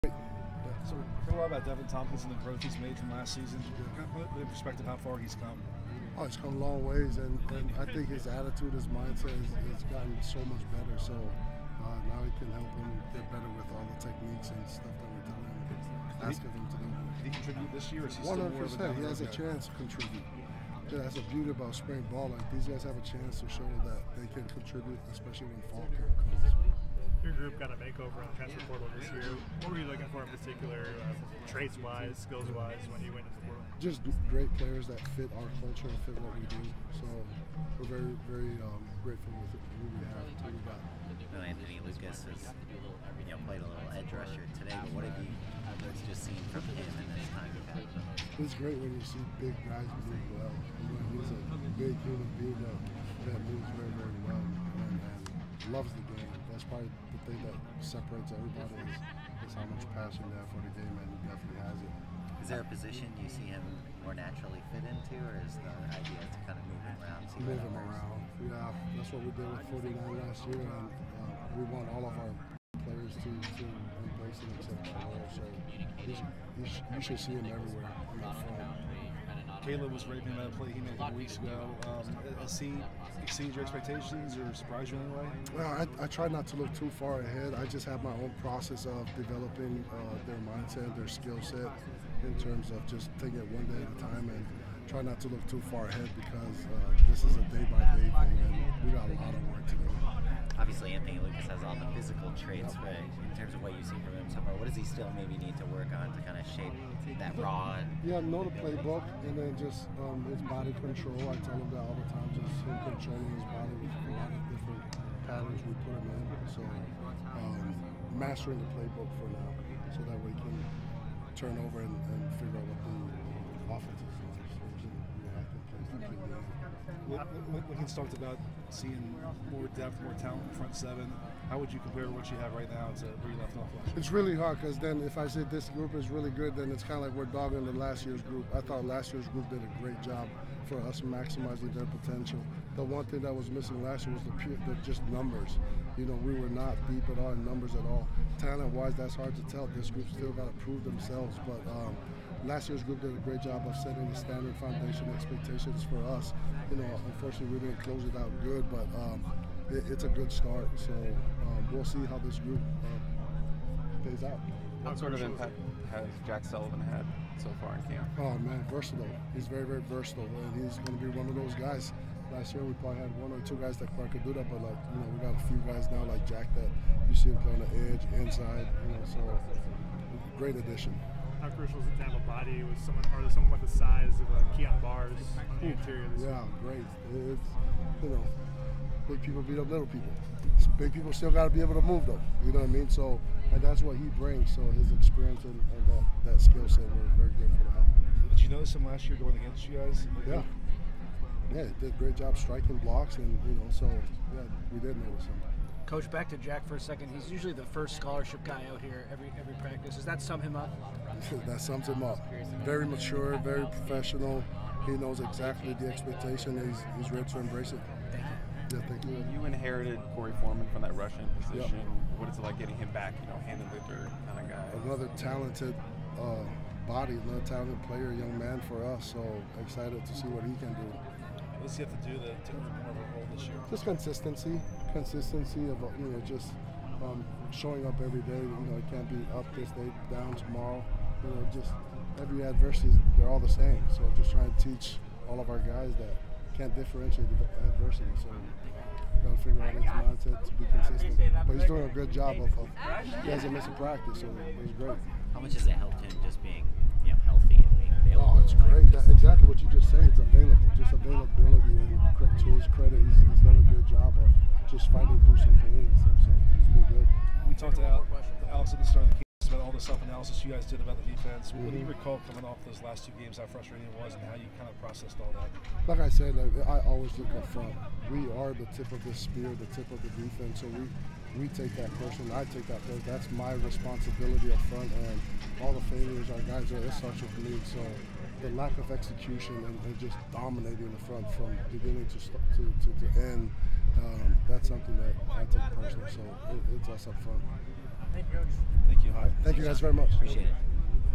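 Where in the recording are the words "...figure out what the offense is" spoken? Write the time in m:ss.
2:02.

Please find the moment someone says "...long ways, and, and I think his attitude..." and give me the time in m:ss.
0:06.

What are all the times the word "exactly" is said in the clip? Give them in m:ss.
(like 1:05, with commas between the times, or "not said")
3:35, 4:19.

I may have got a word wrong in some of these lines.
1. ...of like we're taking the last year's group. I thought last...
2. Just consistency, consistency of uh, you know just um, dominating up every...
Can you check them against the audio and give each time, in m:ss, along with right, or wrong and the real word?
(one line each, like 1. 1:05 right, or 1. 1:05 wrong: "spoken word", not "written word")
1. 2:17 wrong: "dogging", not "taking"
2. 3:53 wrong: "showing", not "dominating".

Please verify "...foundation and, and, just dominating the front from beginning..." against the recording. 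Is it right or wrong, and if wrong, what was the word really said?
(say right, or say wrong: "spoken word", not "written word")
wrong: "execution", not "foundation".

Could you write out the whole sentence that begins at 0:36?
So we're very, very um, grateful with group we have.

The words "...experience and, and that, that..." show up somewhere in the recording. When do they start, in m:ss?
3:14.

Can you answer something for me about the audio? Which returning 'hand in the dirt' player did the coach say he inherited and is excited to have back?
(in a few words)
Korey Foreman.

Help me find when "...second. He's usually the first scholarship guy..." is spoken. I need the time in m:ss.
3:26.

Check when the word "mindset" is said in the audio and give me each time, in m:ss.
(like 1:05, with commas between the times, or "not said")
0:08, 1:30, 4:09.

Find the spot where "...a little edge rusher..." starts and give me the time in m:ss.
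0:43.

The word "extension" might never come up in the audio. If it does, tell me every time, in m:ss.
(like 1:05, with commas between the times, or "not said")
not said.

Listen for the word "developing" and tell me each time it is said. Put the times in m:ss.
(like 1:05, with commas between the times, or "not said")
1:29.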